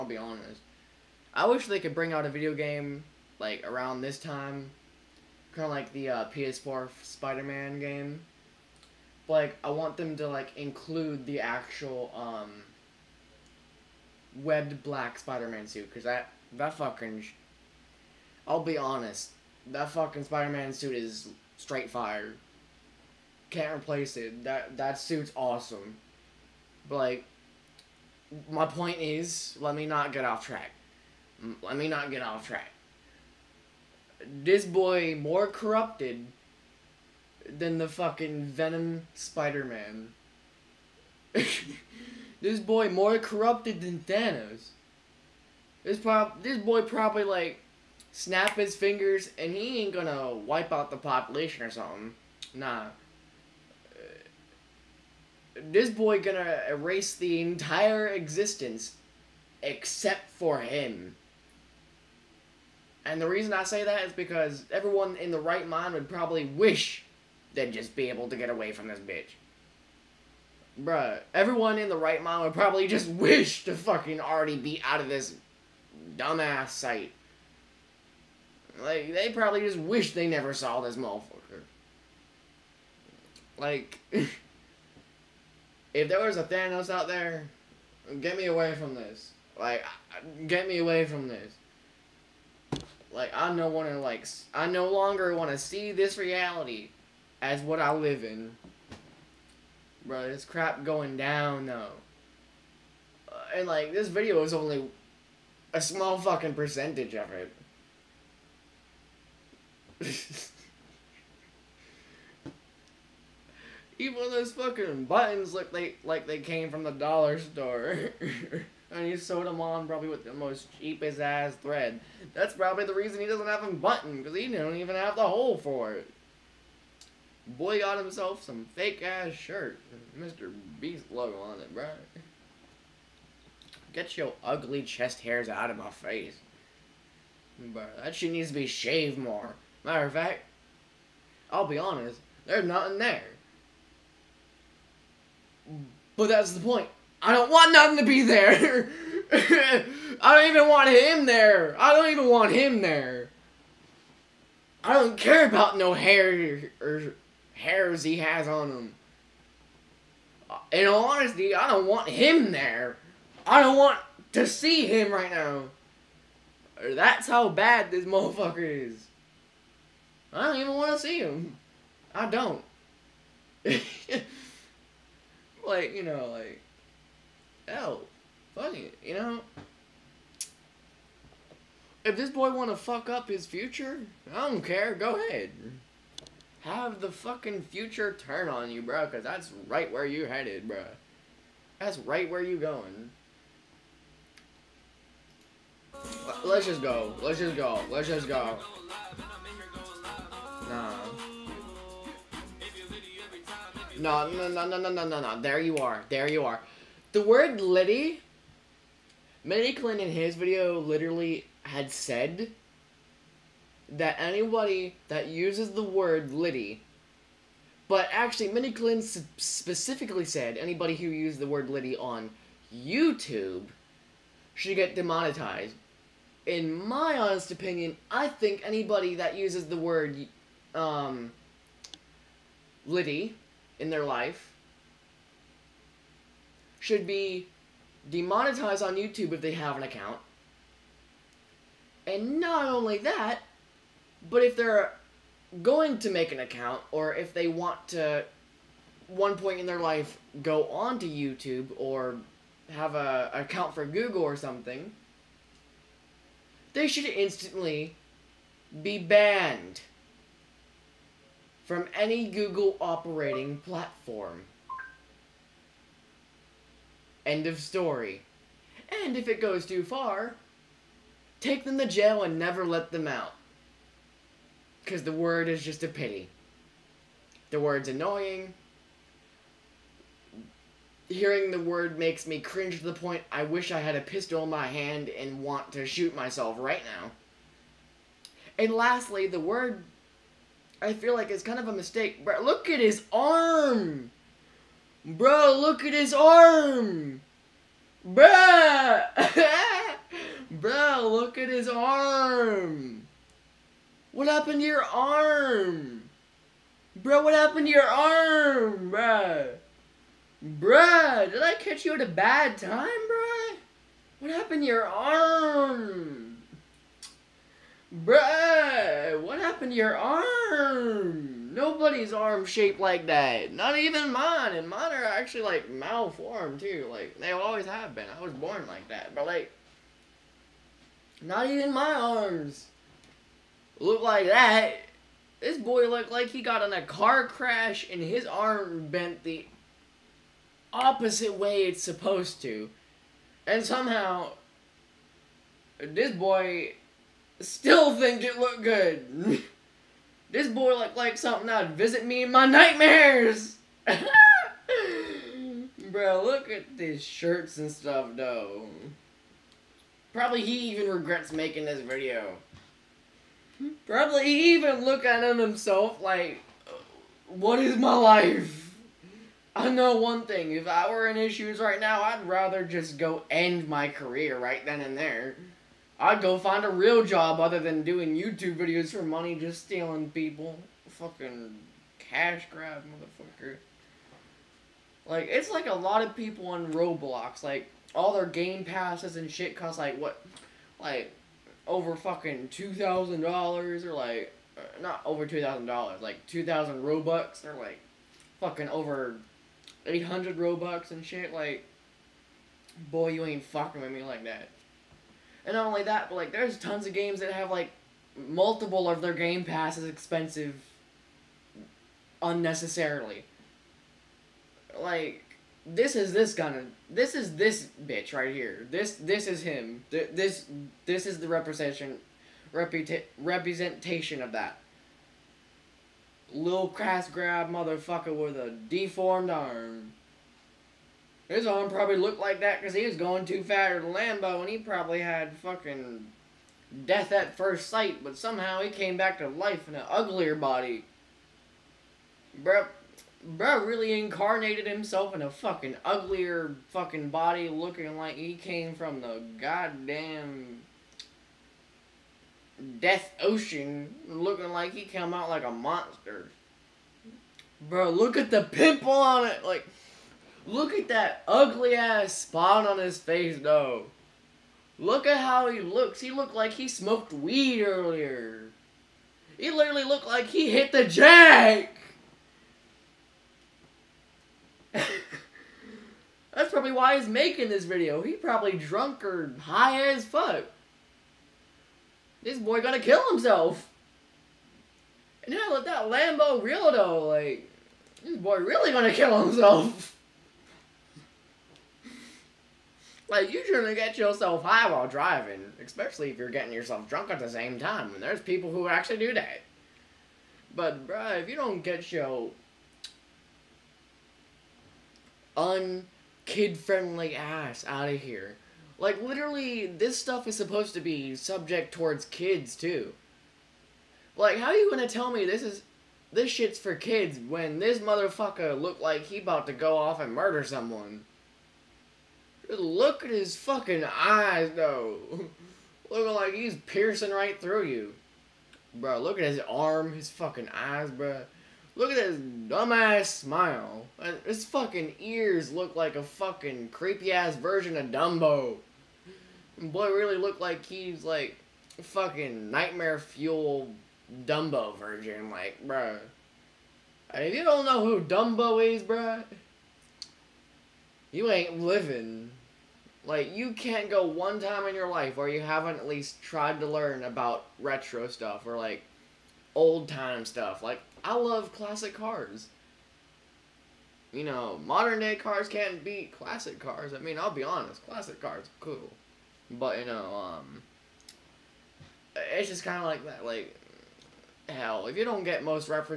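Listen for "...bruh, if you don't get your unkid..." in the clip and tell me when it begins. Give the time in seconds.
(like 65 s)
500 s.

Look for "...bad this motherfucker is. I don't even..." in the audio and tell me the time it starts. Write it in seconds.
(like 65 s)
167 s.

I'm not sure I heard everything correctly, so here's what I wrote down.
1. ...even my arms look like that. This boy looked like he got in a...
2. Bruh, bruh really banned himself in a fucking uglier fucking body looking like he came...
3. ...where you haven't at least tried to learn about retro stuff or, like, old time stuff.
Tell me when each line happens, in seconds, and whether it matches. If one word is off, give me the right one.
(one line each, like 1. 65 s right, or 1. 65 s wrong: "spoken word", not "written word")
1. 331 s right
2. 442 s wrong: "incarnated", not "banned"
3. 555 s right.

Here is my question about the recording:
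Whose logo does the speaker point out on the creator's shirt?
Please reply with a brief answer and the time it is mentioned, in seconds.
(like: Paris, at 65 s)
Mr. Beast, at 130 s.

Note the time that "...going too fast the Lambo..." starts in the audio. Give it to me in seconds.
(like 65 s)
432 s.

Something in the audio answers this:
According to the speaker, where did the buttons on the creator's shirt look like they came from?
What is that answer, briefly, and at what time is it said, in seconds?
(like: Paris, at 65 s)
the dollar store, at 116 s.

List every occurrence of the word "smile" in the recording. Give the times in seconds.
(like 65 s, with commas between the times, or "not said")
533 s.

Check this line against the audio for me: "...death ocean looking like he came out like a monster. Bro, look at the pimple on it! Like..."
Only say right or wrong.
right.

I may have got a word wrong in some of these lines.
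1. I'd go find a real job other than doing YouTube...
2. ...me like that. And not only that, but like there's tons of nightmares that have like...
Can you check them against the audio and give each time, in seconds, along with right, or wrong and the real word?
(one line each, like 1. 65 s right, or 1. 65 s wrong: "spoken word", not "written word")
1. 375 s right
2. 403 s wrong: "games", not "nightmares".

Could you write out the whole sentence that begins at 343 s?
And somehow, this boy still think it looked good.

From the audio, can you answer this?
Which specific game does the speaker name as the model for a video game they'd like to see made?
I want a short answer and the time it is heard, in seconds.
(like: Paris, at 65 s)
PS4 Spider-Man, at 6 s.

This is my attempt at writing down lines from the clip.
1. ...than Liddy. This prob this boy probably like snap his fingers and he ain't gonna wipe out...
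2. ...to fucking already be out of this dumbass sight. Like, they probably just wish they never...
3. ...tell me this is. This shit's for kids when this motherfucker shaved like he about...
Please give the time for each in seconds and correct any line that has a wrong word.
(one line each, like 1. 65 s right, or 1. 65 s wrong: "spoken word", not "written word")
1. 43 s wrong: "Thanos", not "Liddy"
2. 73 s right
3. 514 s wrong: "looked", not "shaved".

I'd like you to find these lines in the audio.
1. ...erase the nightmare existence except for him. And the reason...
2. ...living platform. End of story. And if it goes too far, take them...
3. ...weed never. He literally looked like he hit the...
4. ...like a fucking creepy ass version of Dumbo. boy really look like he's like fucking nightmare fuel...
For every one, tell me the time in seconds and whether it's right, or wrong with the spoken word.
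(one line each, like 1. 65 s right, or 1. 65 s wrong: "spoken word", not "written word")
1. 56 s wrong: "entire", not "nightmare"
2. 262 s wrong: "operating", not "living"
3. 467 s wrong: "earlier", not "never"
4. 535 s right.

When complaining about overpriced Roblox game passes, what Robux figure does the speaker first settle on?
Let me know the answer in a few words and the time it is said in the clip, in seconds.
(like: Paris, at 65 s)
2,000 Robux, at 396 s.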